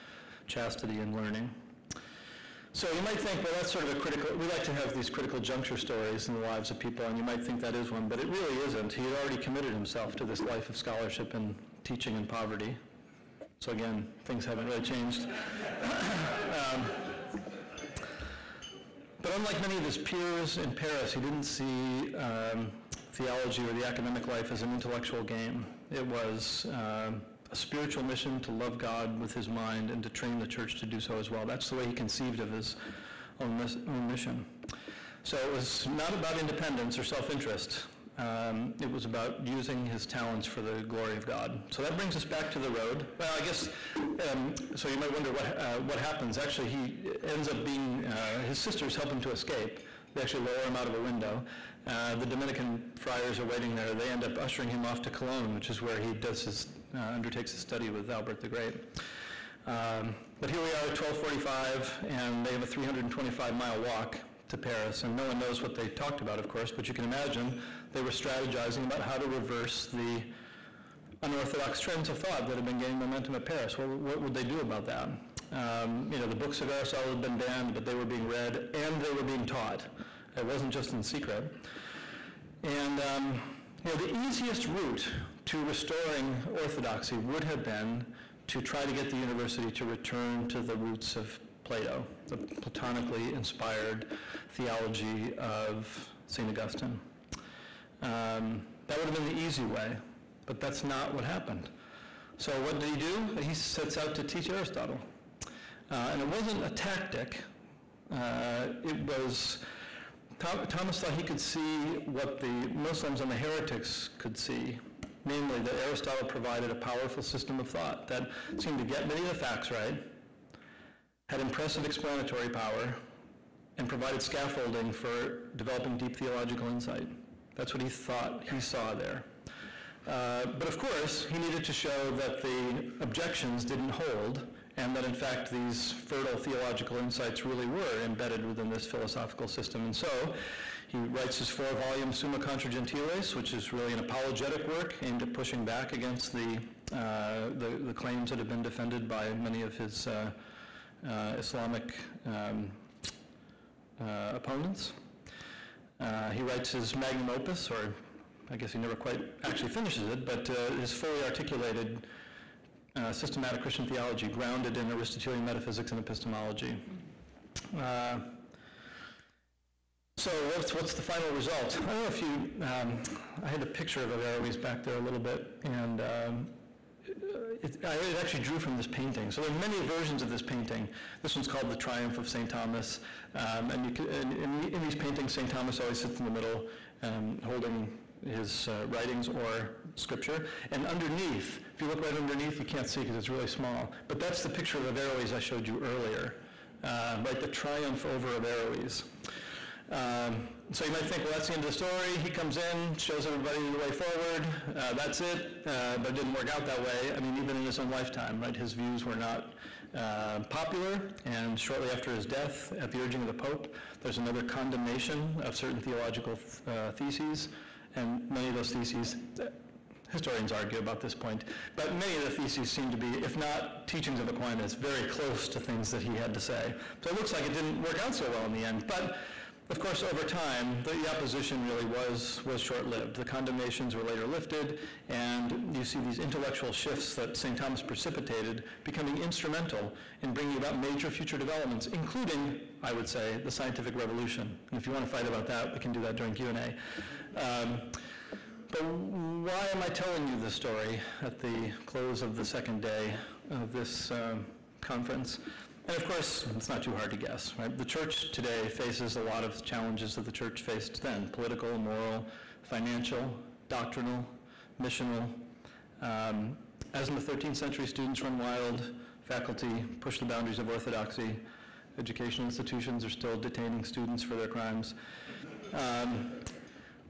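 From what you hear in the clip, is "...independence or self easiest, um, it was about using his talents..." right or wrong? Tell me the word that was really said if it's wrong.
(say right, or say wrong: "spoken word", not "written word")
wrong: "interest", not "easiest".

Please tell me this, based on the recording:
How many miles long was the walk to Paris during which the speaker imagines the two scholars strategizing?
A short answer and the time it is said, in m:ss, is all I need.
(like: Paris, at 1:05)
325 miles, at 1:02.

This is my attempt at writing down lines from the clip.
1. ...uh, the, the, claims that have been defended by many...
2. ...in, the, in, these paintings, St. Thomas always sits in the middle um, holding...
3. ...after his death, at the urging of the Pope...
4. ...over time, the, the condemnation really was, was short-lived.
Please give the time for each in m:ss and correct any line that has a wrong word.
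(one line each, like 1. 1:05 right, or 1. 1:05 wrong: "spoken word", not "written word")
1. 2:26 right
2. 3:04 right
3. 3:31 right
4. 3:50 wrong: "opposition", not "condemnation".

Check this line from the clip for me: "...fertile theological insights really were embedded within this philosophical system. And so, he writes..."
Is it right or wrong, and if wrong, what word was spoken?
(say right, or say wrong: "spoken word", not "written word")
right.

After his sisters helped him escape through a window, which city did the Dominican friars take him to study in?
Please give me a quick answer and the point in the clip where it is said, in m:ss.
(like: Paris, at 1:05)
Cologne, at 0:55.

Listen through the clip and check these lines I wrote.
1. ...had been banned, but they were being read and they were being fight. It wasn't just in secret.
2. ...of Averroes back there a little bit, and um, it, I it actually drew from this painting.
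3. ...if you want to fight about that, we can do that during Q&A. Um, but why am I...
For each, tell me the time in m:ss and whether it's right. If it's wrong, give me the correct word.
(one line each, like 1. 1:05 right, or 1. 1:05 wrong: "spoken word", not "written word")
1. 1:17 wrong: "taught", not "fight"
2. 2:54 right
3. 4:04 right.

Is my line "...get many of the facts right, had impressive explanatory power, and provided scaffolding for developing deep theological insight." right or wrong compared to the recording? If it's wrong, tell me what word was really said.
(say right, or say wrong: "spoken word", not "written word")
right.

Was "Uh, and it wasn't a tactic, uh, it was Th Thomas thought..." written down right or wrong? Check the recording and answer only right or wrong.
right.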